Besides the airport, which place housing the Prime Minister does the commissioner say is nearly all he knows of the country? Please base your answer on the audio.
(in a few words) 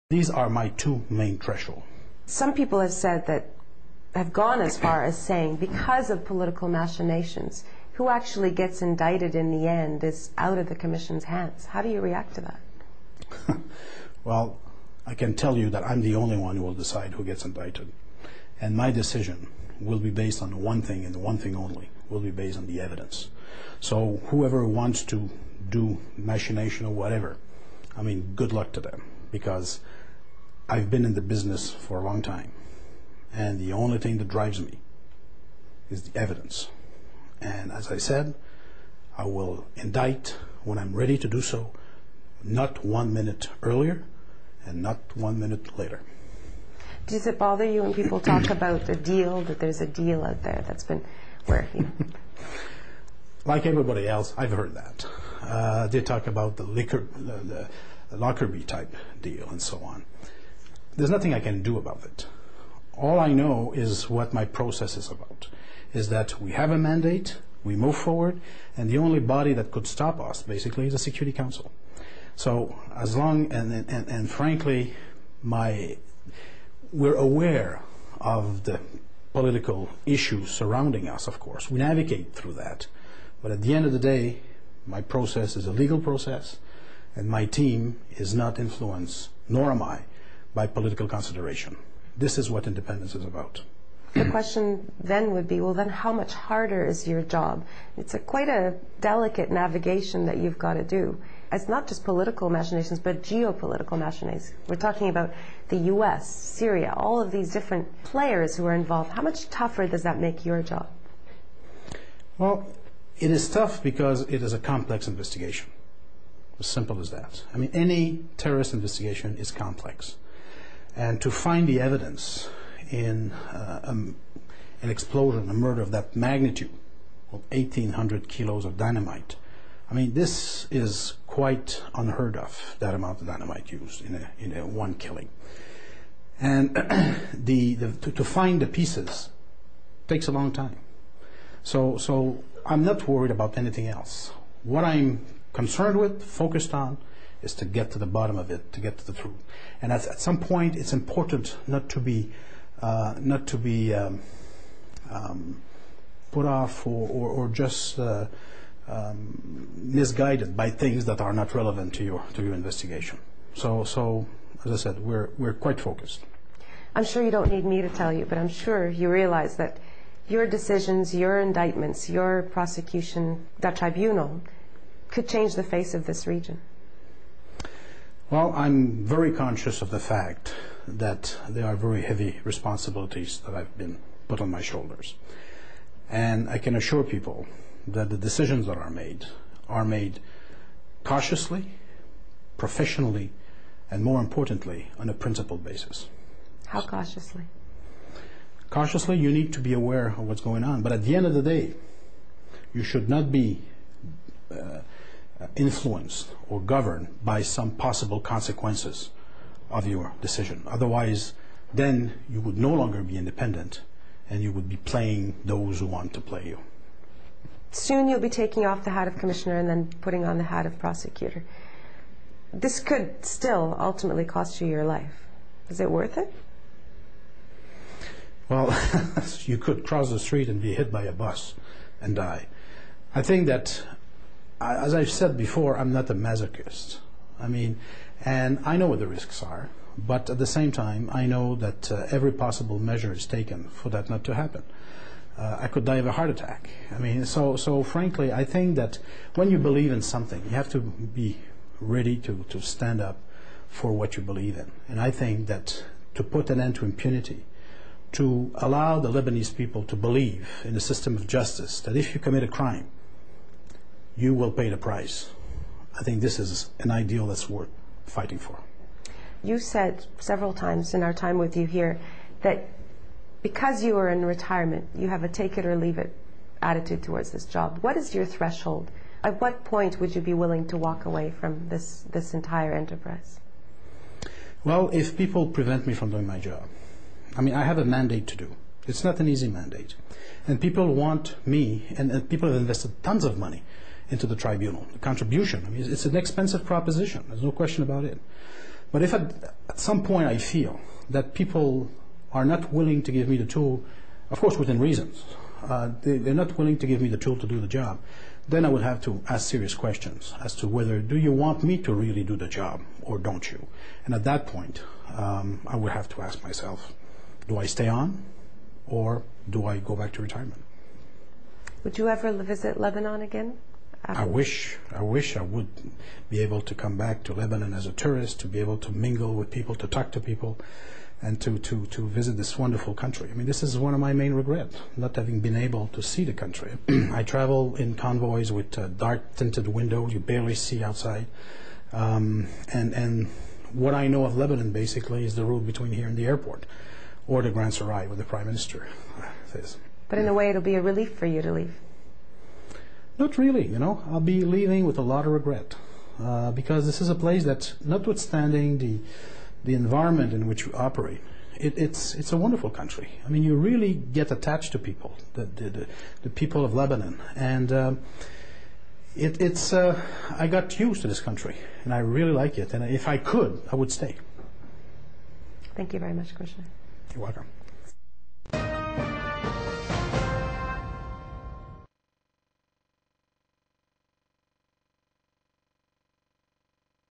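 the Grand Sarai.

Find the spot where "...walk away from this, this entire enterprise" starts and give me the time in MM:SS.
04:40.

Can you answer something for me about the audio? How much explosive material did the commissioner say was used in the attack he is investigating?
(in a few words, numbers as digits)
1,800 kilos.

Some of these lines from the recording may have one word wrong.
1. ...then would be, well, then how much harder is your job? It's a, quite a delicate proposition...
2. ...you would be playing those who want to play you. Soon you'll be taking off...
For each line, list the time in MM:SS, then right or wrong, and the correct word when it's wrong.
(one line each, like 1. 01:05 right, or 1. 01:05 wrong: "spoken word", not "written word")
1. 01:35 wrong: "navigation", not "proposition"
2. 03:34 right.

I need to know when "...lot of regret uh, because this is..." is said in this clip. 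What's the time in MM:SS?
05:55.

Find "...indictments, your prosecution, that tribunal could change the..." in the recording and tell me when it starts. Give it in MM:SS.
02:51.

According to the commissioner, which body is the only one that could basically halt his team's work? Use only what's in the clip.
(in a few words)
the Security Council.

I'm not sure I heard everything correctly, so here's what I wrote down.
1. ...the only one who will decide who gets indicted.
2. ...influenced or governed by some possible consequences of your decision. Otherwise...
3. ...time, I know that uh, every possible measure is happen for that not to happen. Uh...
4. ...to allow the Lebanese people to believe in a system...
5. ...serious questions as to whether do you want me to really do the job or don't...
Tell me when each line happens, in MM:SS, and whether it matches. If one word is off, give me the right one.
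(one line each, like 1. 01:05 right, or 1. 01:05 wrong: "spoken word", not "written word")
1. 00:16 right
2. 03:25 right
3. 04:00 wrong: "taken", not "happen"
4. 04:18 right
5. 05:09 right.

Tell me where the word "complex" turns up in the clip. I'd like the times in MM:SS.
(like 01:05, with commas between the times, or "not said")
01:54, 01:59.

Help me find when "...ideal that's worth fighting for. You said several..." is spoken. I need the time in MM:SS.
04:26.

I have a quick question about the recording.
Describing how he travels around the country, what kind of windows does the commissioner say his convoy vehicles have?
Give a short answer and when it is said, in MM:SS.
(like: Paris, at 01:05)
dark tinted windows, at 05:38.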